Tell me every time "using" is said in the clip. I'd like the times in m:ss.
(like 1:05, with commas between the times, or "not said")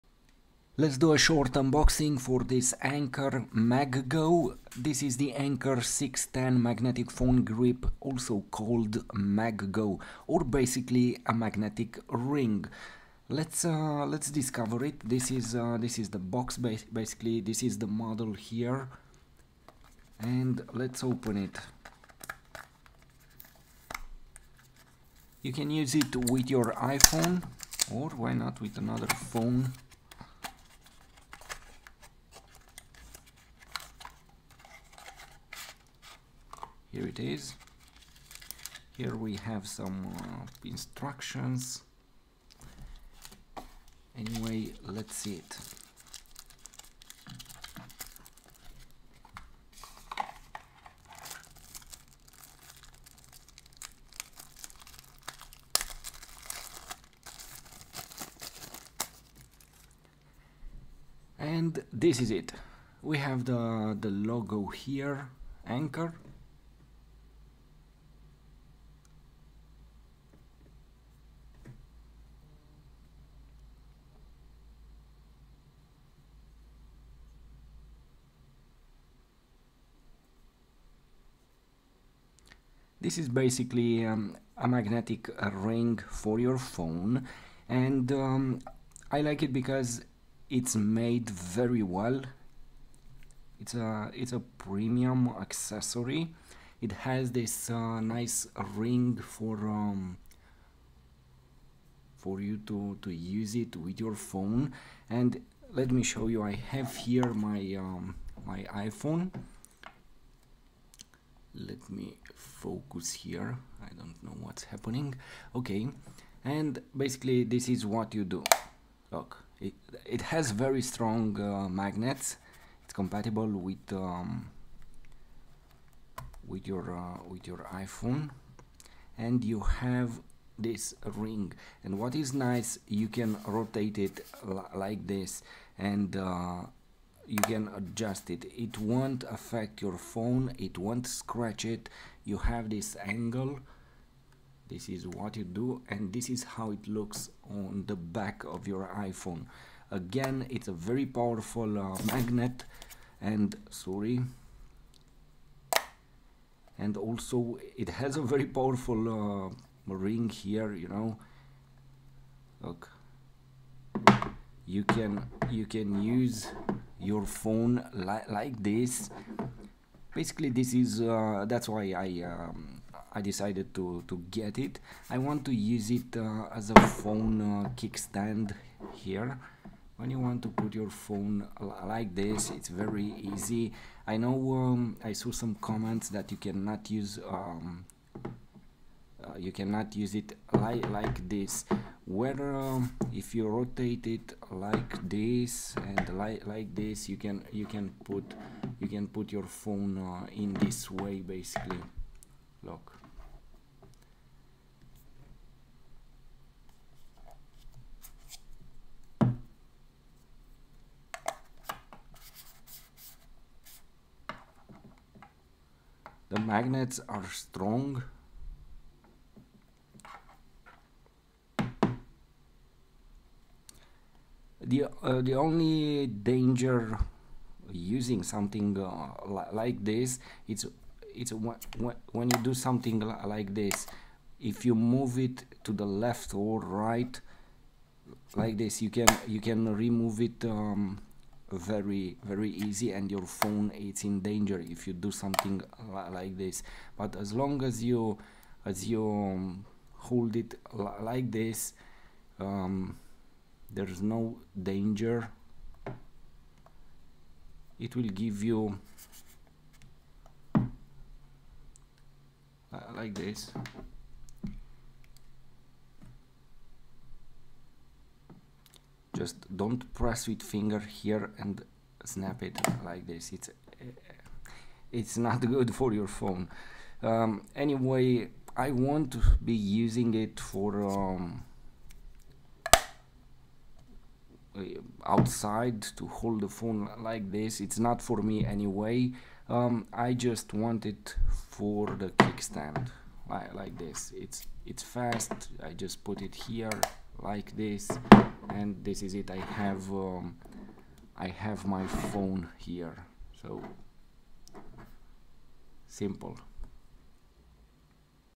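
3:47, 4:39.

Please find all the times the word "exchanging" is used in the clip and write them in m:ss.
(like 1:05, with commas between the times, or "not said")
not said.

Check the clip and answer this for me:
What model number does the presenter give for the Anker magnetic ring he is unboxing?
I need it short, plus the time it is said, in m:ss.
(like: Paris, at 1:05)
610, at 0:05.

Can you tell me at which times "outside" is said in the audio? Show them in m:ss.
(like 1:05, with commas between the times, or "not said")
4:45.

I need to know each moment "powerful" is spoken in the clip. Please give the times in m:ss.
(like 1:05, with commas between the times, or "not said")
2:31, 2:38.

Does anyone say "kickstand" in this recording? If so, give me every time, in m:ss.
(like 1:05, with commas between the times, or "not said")
2:57, 4:52.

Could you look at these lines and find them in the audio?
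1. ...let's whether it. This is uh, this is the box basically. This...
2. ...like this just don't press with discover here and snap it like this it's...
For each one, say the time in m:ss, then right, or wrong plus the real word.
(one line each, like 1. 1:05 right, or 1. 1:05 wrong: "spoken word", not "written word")
1. 0:14 wrong: "discover", not "whether"
2. 4:22 wrong: "finger", not "discover".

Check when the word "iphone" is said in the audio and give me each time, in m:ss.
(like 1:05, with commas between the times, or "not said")
0:26, 1:48, 2:07, 2:28.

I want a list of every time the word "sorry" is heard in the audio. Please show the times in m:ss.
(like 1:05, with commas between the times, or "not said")
2:33.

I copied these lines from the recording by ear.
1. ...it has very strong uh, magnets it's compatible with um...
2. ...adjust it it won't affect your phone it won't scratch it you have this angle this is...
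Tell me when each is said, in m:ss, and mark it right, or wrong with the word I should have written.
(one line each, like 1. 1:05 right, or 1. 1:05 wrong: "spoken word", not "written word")
1. 2:00 right
2. 2:17 right.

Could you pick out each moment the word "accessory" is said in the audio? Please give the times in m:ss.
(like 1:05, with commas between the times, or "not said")
1:35.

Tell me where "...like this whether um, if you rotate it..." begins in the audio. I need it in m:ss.
3:10.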